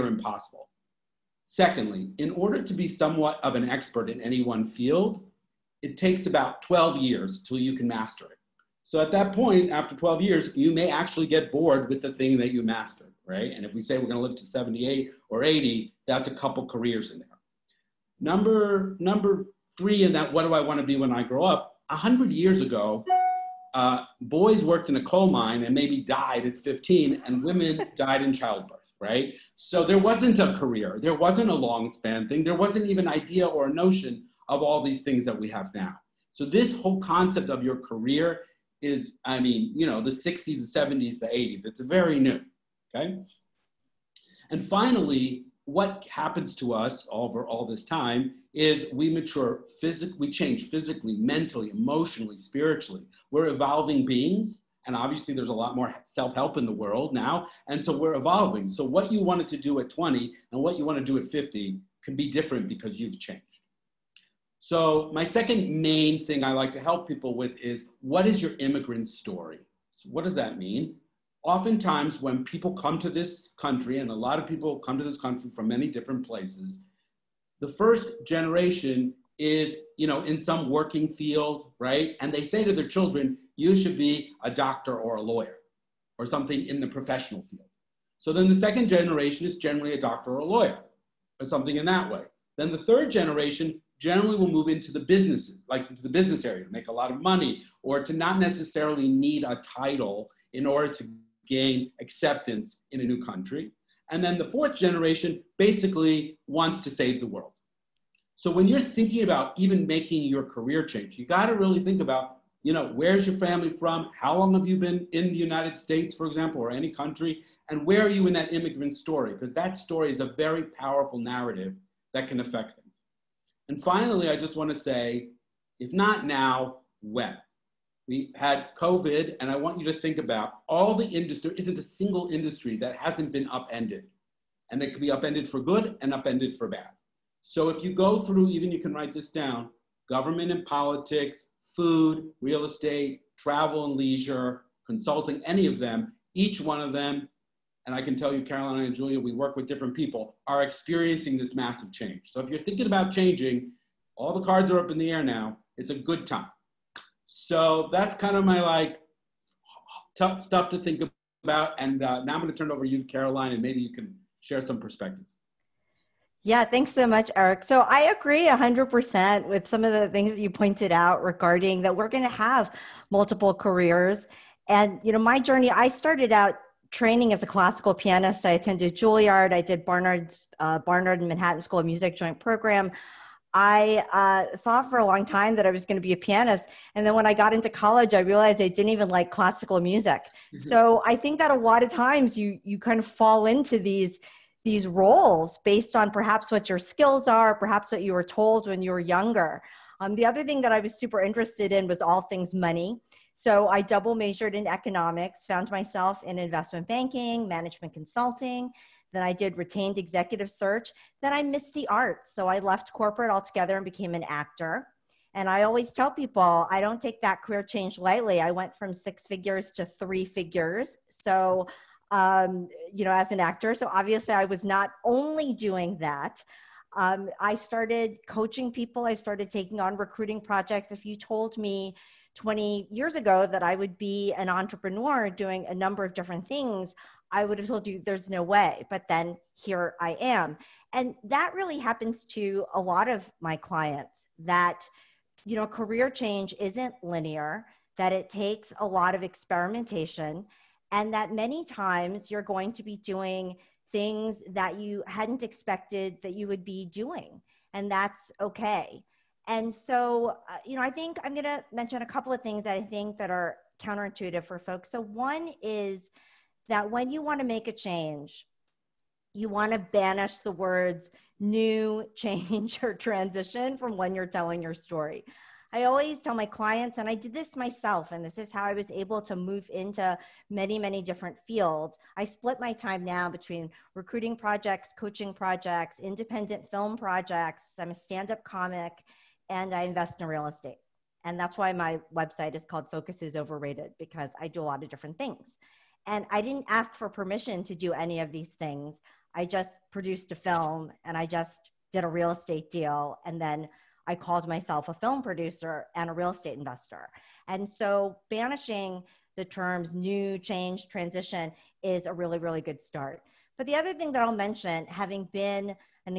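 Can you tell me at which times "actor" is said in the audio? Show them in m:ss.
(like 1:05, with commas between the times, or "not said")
3:34, 3:43.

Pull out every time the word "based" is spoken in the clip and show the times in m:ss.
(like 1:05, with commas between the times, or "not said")
3:15.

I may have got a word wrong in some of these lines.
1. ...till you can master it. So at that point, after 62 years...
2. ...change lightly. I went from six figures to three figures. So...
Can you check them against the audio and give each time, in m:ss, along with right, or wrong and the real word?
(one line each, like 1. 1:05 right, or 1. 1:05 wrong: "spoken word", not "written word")
1. 0:07 wrong: "12", not "62"
2. 3:37 right.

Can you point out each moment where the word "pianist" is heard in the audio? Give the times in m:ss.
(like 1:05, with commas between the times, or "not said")
2:57, 3:06.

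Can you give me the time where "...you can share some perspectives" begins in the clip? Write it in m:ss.
2:43.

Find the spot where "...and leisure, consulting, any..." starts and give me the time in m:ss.
2:23.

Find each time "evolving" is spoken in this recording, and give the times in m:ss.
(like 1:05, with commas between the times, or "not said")
0:53, 0:58.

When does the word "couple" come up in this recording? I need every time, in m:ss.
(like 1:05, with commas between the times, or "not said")
0:16, 4:22.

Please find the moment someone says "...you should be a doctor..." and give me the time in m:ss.
1:23.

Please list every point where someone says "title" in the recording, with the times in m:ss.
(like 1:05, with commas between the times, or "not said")
1:39.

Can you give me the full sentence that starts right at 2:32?
So if you're thinking about changing, all the cards are up in the air now, it's a good time.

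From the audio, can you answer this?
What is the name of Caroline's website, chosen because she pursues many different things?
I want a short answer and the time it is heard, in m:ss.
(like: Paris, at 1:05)
Focus is Overrated, at 4:52.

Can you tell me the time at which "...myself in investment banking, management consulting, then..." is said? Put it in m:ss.
3:25.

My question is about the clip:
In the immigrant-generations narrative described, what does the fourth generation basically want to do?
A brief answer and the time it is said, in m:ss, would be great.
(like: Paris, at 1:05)
save the world, at 1:46.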